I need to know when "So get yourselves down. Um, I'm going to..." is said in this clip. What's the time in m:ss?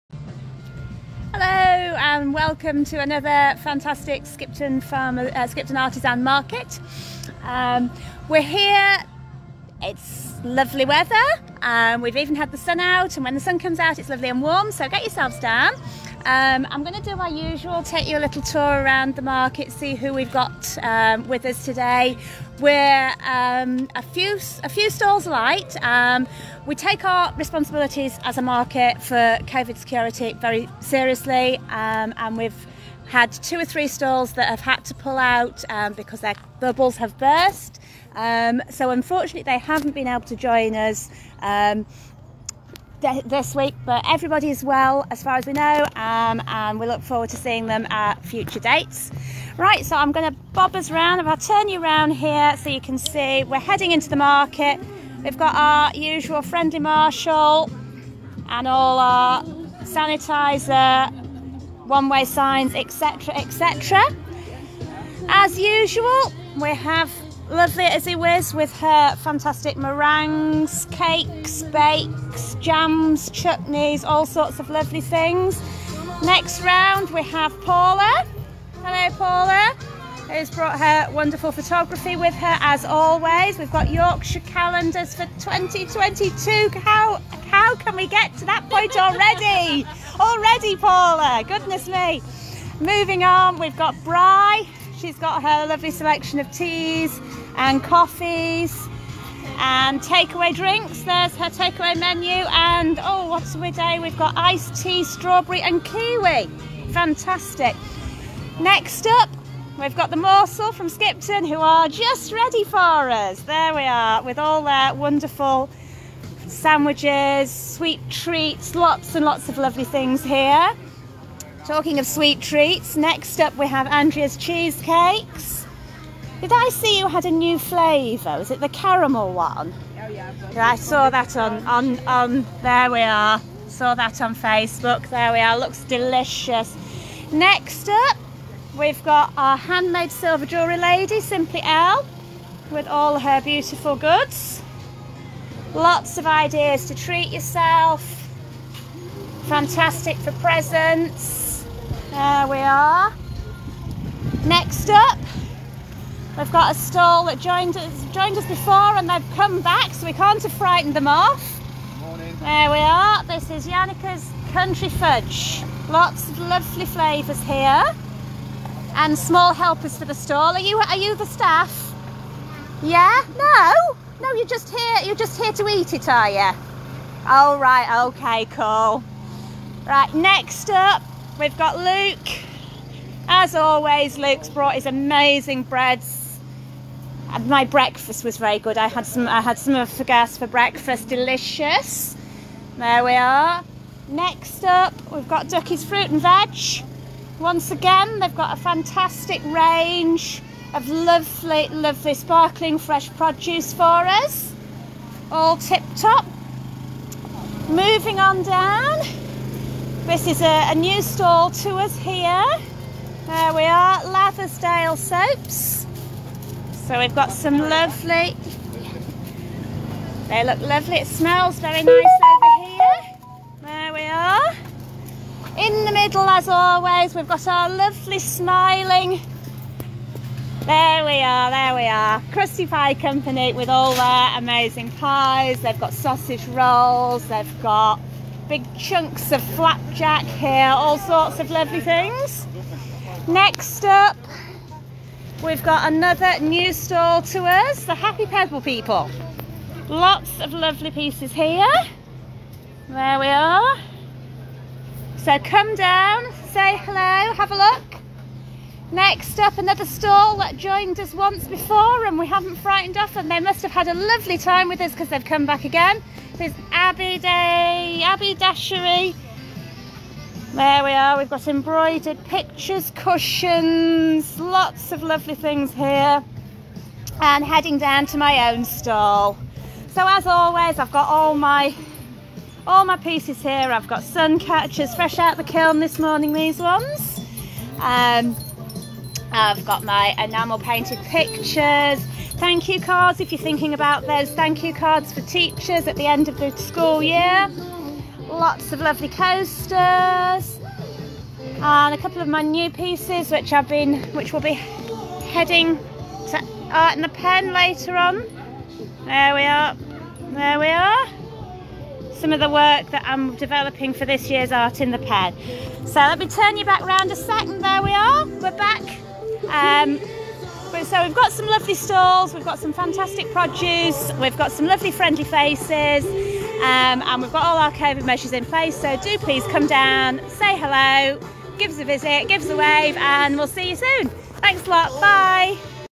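0:14.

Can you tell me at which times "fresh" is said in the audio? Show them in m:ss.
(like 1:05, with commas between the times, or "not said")
3:22, 4:44.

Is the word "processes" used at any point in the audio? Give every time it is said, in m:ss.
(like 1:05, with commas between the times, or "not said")
not said.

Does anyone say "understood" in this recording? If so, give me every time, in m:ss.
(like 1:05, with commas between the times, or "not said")
not said.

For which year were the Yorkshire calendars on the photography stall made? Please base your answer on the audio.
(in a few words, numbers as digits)
2022.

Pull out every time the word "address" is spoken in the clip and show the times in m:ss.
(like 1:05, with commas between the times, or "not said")
not said.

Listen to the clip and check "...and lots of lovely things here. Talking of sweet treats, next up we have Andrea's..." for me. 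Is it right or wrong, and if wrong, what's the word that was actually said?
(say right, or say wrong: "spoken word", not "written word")
right.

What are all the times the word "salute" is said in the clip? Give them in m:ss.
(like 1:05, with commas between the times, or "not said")
not said.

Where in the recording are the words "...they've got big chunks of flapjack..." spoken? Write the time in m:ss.
3:57.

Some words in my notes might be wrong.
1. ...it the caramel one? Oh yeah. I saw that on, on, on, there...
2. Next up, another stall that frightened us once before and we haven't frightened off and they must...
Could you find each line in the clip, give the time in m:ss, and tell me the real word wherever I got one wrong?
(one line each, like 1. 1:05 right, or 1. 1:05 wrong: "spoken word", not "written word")
1. 2:08 right
2. 4:18 wrong: "joined", not "frightened".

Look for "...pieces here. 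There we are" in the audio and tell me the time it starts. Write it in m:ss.
4:10.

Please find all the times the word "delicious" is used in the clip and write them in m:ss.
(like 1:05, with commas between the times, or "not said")
2:15, 3:11.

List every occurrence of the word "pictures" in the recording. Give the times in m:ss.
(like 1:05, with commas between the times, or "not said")
4:32, 4:50.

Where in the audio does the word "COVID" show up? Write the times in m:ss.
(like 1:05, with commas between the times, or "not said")
0:29, 5:27.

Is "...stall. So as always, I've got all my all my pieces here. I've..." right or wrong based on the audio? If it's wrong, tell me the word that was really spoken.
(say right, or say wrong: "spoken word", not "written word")
right.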